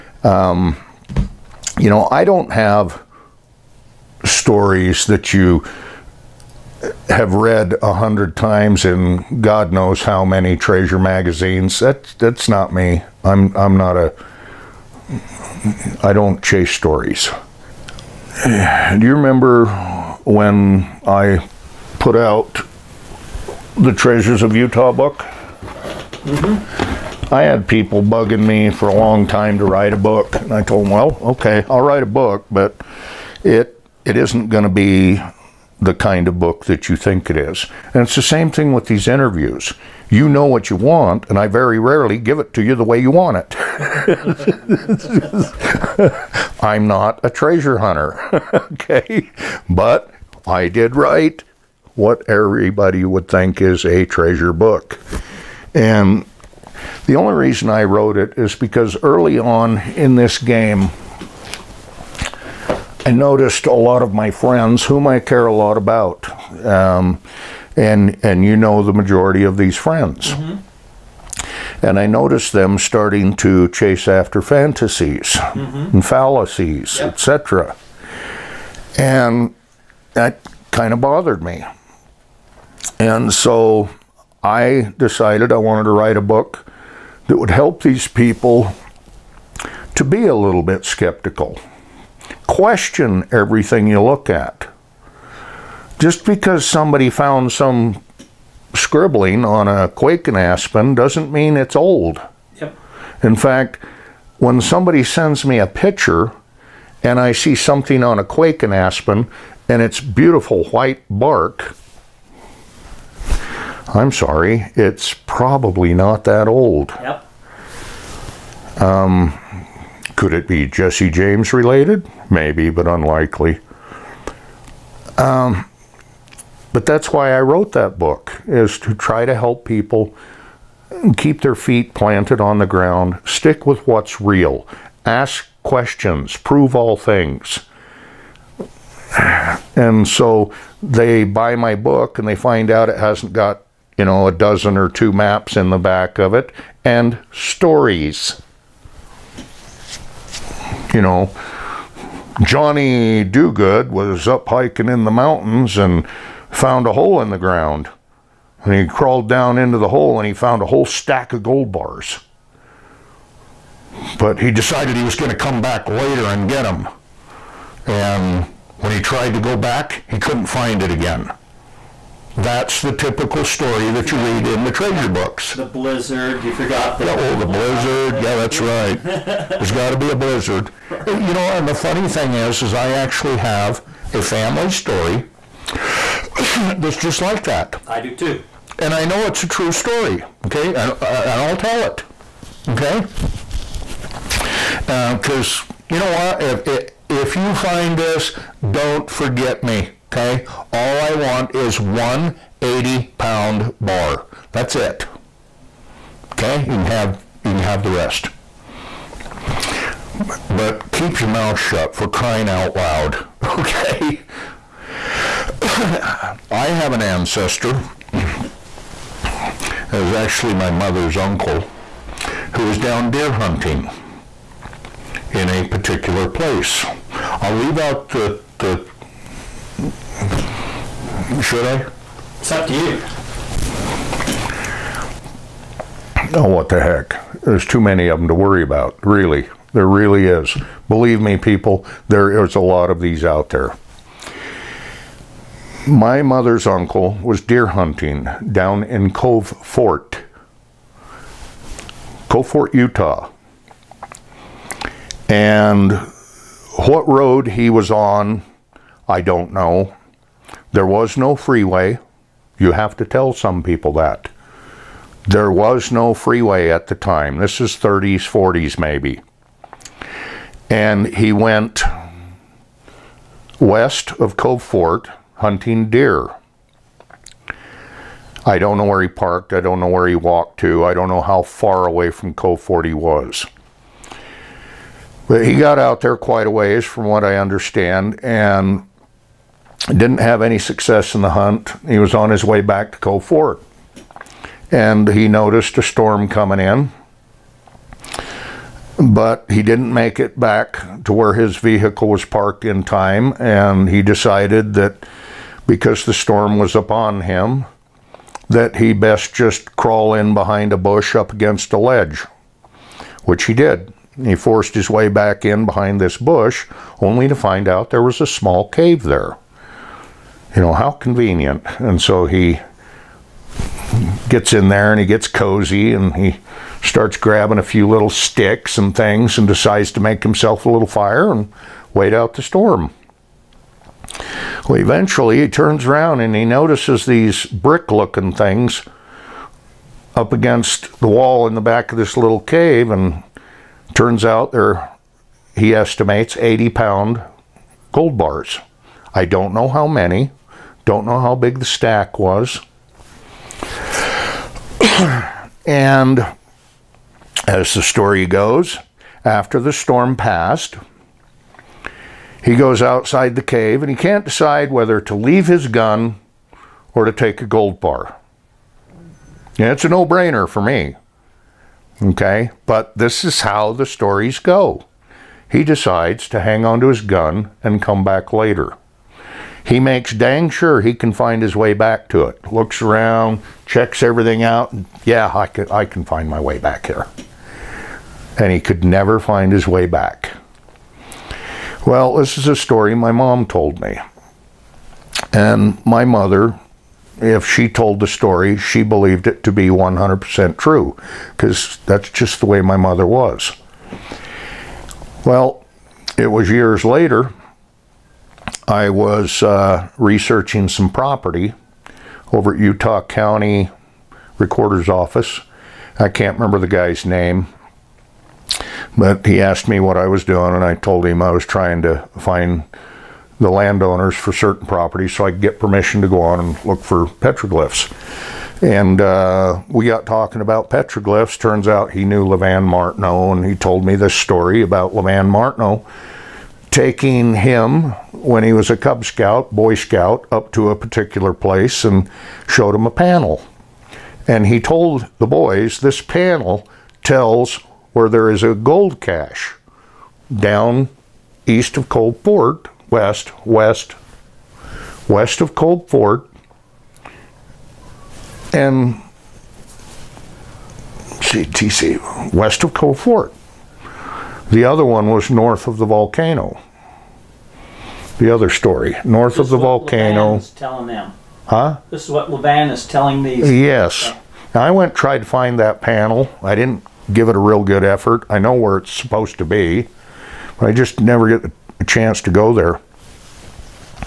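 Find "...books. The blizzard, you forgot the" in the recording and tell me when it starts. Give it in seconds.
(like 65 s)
175 s.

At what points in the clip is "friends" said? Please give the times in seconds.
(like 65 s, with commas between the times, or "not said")
64 s, 69 s.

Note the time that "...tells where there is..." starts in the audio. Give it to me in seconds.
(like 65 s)
447 s.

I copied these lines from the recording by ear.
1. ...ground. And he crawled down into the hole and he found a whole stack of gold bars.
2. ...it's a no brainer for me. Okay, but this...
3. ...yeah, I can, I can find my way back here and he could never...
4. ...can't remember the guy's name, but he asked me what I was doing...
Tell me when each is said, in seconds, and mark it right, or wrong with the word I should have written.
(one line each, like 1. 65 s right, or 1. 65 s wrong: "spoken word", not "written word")
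1. 157 s right
2. 369 s right
3. 385 s right
4. 416 s right.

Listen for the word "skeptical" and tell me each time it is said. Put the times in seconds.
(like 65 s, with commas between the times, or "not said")
90 s.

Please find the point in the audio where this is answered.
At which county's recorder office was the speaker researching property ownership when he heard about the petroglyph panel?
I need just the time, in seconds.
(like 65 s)
412 s.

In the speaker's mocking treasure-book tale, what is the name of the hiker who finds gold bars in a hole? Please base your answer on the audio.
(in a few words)
Johnny Duguid.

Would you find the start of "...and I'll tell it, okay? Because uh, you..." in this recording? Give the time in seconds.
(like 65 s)
191 s.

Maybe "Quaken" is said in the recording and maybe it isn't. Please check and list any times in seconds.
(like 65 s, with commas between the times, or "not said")
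99 s, 108 s.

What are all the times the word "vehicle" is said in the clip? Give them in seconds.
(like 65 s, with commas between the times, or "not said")
301 s.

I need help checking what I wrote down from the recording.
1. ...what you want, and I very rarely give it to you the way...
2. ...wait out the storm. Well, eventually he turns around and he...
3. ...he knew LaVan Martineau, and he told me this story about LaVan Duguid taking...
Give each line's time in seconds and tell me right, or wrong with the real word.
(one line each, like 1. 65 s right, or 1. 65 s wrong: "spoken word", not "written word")
1. 40 s right
2. 331 s right
3. 431 s wrong: "Martineau", not "Duguid".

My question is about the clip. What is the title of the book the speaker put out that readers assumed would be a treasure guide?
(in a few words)
Treasures of Utah.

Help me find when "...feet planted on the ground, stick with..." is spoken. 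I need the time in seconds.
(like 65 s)
131 s.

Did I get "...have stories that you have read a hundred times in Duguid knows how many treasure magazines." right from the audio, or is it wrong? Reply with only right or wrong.
wrong.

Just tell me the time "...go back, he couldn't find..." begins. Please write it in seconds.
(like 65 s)
169 s.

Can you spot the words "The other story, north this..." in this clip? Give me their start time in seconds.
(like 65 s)
468 s.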